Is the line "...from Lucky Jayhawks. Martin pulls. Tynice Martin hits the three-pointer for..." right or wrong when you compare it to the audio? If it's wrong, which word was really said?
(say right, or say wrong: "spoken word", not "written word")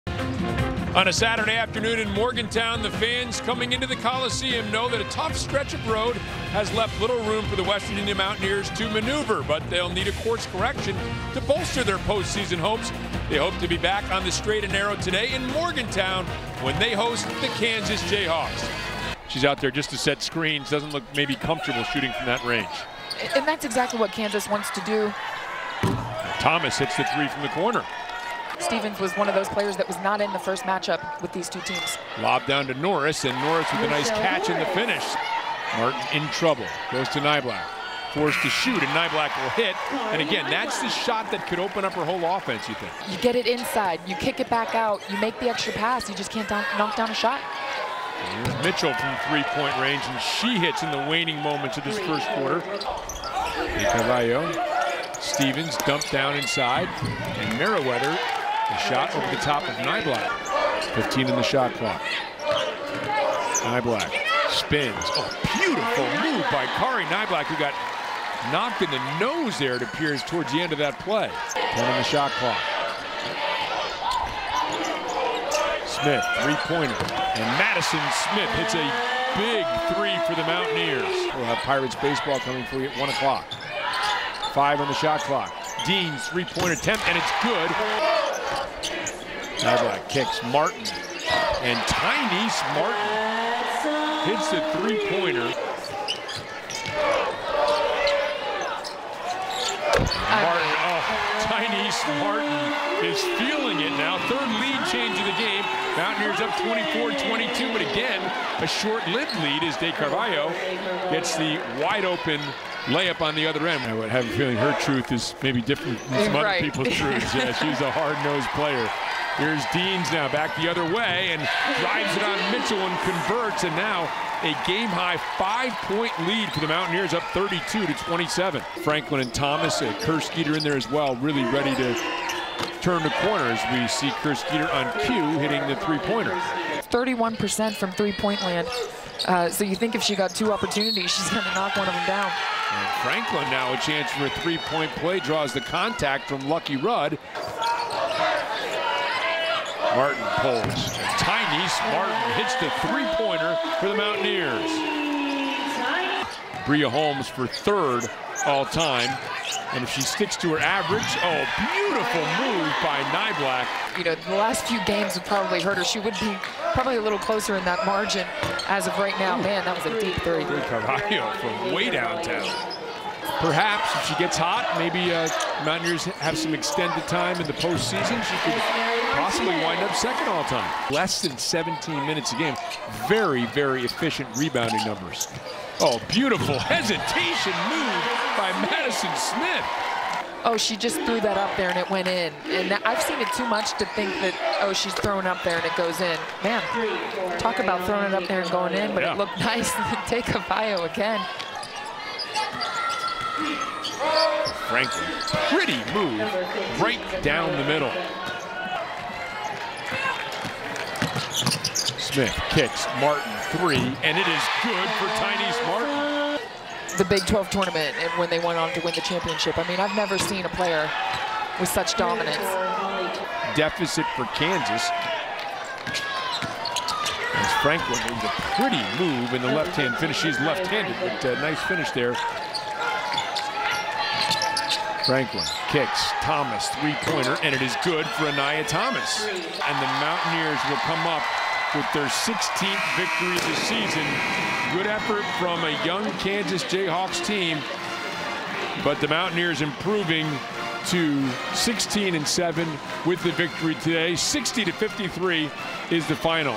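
wrong: "Rudd", not "Jayhawks".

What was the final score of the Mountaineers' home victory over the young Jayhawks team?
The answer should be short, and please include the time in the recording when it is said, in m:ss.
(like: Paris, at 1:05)
60-53, at 4:14.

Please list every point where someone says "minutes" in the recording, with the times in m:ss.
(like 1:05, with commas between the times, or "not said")
3:02.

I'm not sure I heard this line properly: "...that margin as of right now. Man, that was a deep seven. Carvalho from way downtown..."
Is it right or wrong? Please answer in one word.
wrong.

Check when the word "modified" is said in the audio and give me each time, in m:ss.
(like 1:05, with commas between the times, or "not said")
not said.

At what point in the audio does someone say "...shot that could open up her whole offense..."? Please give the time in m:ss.
0:40.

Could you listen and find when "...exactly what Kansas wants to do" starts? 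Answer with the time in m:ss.
0:23.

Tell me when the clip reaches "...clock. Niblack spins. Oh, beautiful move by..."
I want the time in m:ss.
1:01.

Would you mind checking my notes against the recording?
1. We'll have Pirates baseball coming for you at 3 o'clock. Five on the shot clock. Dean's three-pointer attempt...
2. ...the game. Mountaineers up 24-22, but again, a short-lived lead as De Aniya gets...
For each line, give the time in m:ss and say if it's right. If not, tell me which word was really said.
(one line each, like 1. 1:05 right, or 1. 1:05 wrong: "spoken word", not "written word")
1. 1:21 wrong: "1", not "3"
2. 1:45 wrong: "Carvalho", not "Aniya".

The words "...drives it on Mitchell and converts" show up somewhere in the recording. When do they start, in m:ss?
2:01.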